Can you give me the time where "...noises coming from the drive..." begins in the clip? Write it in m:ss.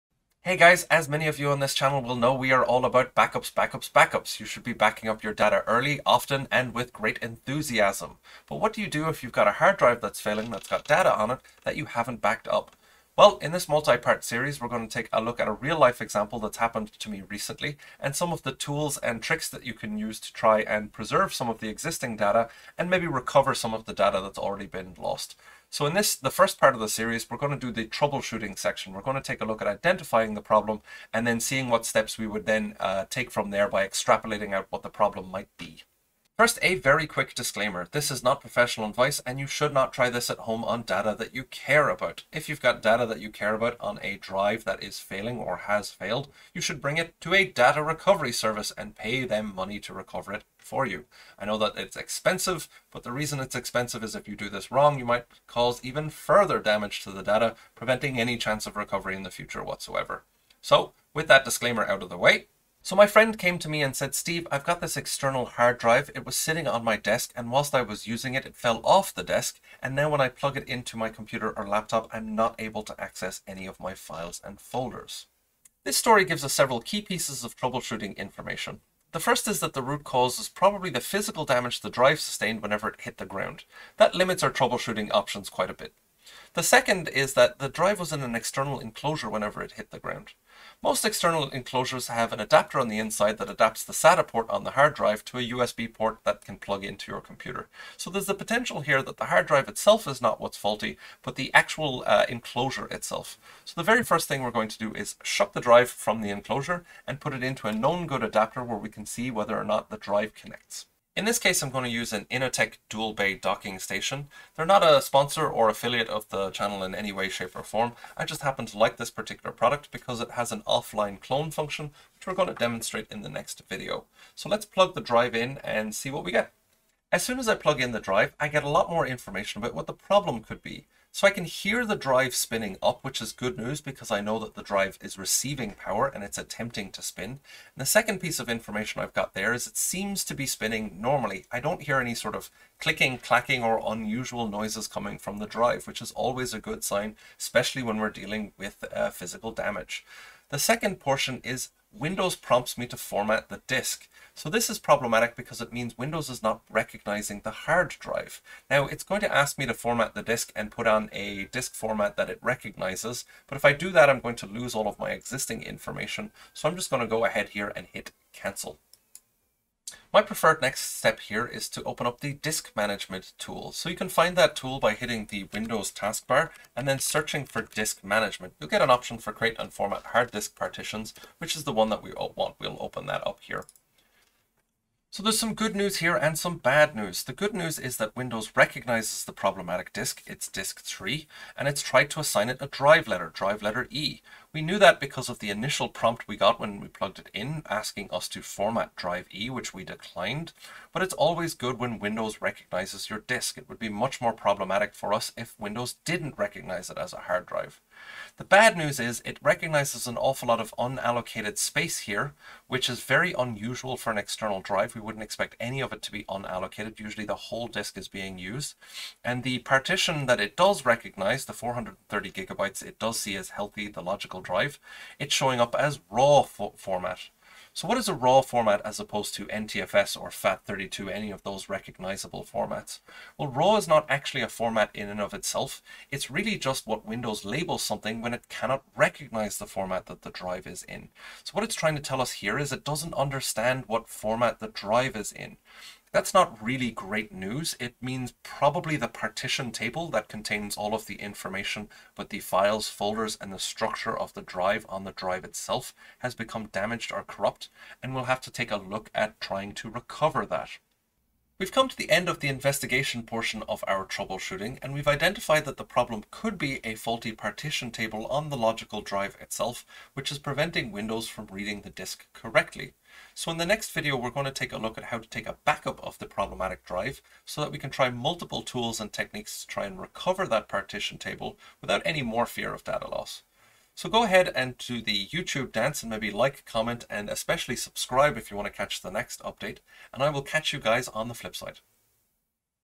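2:24.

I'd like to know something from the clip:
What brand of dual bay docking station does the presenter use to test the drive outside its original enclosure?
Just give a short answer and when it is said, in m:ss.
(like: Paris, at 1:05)
Inateck, at 1:52.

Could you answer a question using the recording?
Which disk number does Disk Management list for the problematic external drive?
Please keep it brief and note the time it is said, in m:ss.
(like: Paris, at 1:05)
3, at 3:10.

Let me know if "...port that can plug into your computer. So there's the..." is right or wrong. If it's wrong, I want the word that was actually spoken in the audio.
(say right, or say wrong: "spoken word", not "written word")
right.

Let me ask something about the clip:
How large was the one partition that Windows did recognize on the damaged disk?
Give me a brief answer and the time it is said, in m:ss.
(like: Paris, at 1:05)
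430 gigabytes, at 3:41.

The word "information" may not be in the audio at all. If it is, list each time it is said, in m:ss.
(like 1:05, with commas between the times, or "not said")
1:18, 2:09, 2:18, 2:45, 4:11.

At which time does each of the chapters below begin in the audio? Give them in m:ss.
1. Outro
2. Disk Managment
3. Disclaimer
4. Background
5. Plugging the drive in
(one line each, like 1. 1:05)
1. 4:23
2. 2:50
3. 0:35
4. 1:02
5. 2:07.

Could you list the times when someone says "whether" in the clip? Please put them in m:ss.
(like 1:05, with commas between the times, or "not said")
1:49.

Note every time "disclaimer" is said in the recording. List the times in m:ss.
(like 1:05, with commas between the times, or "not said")
0:37, 1:01.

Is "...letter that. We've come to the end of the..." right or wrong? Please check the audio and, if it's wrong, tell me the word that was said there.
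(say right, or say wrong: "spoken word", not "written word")
wrong: "recover", not "letter".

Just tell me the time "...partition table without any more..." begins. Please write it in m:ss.
4:40.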